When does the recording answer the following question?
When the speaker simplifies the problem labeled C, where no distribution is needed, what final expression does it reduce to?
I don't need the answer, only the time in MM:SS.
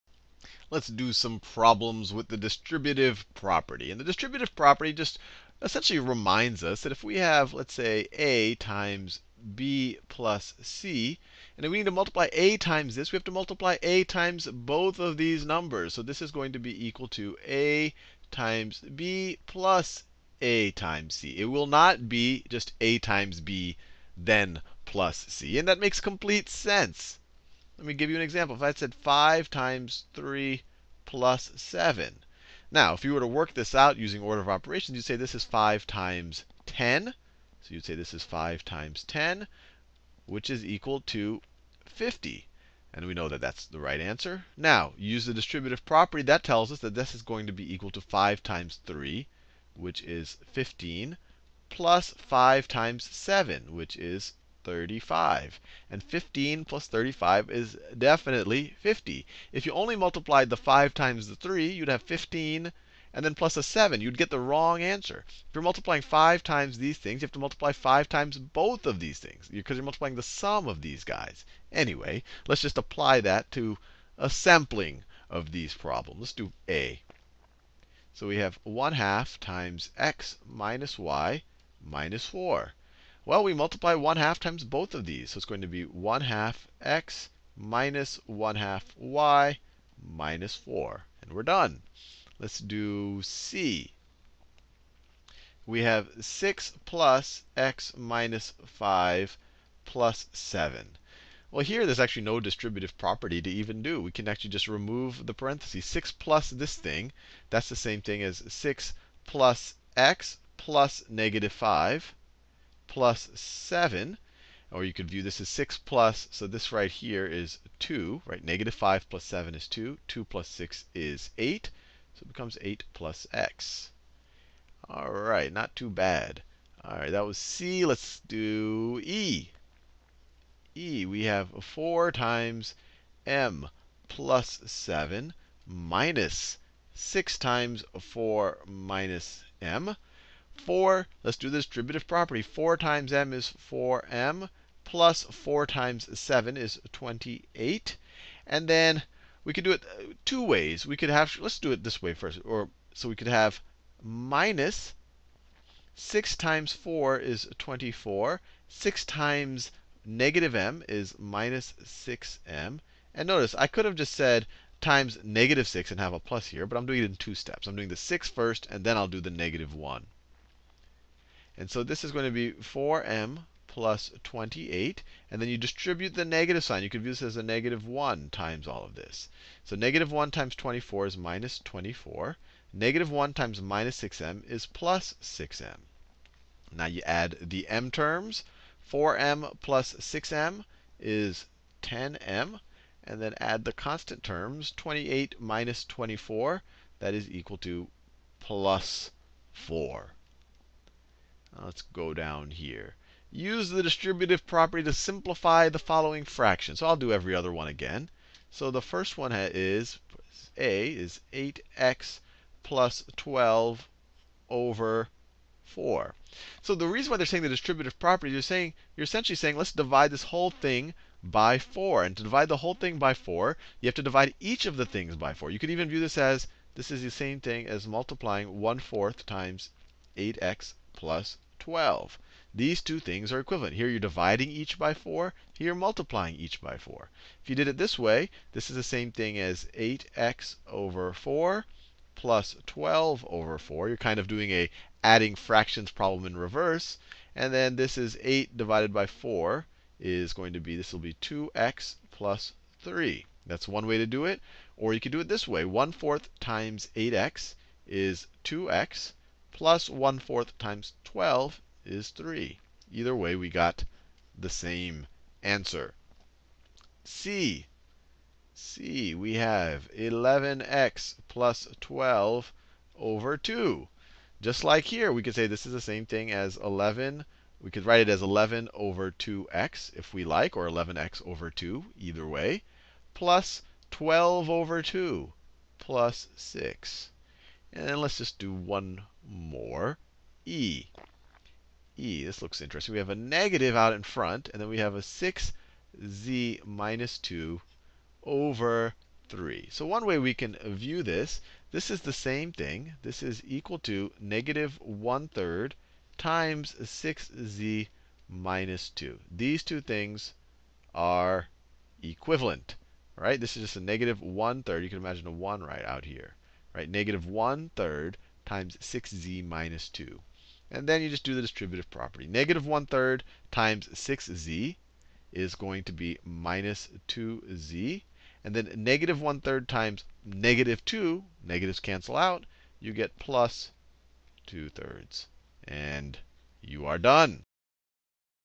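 02:02.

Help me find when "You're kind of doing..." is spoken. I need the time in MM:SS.
04:03.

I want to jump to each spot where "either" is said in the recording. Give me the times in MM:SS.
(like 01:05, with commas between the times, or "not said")
04:22, 04:41.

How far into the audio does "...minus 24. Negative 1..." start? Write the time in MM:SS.
03:01.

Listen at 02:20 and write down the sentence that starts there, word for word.
4, let's do the distributive property.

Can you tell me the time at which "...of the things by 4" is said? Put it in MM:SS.
03:44.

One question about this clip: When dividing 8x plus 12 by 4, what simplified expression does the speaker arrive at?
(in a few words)
2x plus 3.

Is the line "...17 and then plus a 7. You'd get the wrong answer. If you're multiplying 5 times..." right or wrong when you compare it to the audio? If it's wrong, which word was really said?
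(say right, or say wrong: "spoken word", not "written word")
wrong: "15", not "17".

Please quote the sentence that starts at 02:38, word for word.
6 times negative m is minus 6m.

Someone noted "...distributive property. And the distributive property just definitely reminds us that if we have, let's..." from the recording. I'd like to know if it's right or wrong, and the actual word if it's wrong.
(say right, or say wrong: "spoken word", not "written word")
wrong: "essentially", not "definitely".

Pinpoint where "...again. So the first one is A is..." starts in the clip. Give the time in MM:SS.
03:27.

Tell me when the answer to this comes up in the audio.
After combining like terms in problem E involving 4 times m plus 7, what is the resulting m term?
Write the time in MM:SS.
03:11.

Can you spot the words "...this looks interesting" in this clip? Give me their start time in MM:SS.
04:52.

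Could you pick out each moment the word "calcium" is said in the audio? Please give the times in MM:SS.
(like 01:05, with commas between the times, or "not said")
not said.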